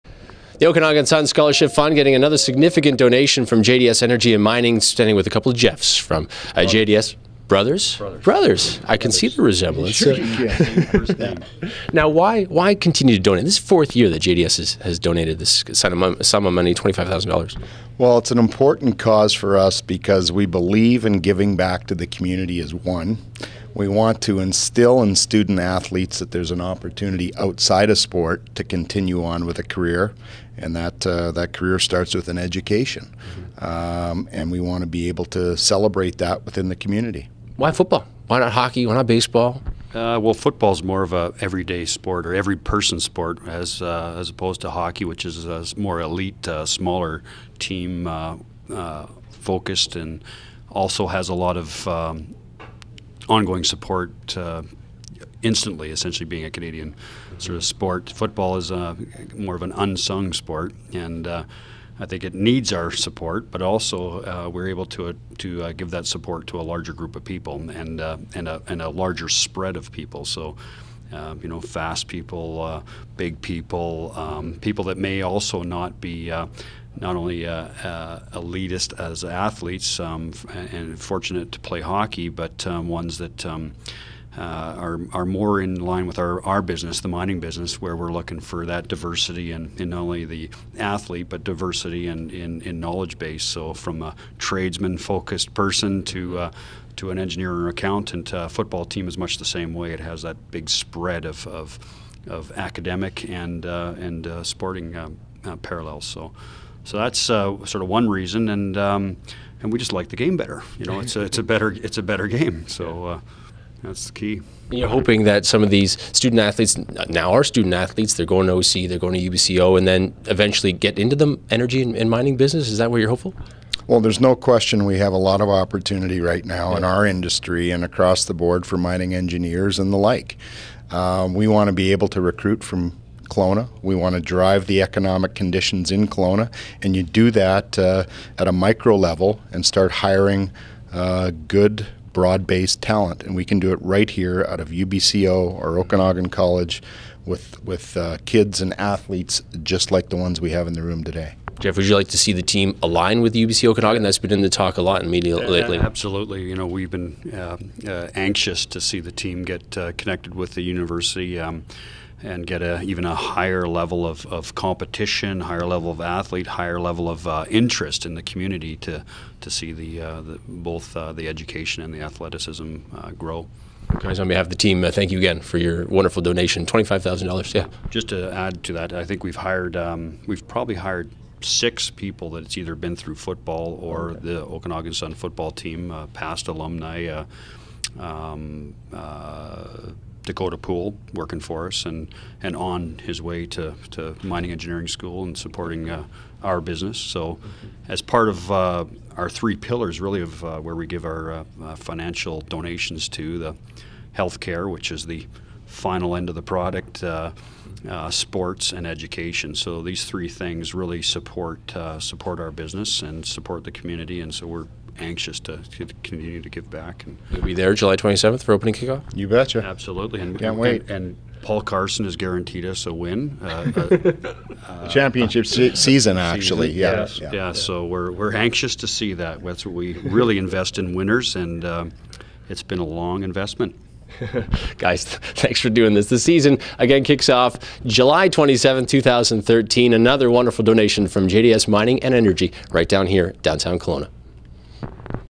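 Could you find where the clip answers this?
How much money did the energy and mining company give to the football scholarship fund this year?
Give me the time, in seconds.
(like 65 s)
16 s.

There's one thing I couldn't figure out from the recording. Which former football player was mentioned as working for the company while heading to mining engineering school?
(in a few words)
Dakota Pool.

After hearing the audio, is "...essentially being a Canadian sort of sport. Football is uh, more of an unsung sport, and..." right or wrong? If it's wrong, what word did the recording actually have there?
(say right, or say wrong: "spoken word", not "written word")
right.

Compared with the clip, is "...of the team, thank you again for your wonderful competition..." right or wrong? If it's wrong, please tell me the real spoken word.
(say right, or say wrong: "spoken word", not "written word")
wrong: "donation", not "competition".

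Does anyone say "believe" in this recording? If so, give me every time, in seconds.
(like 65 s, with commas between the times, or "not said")
20 s.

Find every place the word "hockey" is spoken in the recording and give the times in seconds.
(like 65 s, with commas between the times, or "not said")
38 s, 44 s, 81 s.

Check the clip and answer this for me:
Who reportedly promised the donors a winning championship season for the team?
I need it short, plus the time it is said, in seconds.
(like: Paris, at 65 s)
Paul Carson, at 221 s.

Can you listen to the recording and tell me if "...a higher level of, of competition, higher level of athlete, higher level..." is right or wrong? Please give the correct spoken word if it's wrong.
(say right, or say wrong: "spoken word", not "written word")
right.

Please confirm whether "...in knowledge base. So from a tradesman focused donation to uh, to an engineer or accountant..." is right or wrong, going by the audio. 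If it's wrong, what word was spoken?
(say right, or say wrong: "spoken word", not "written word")
wrong: "person", not "donation".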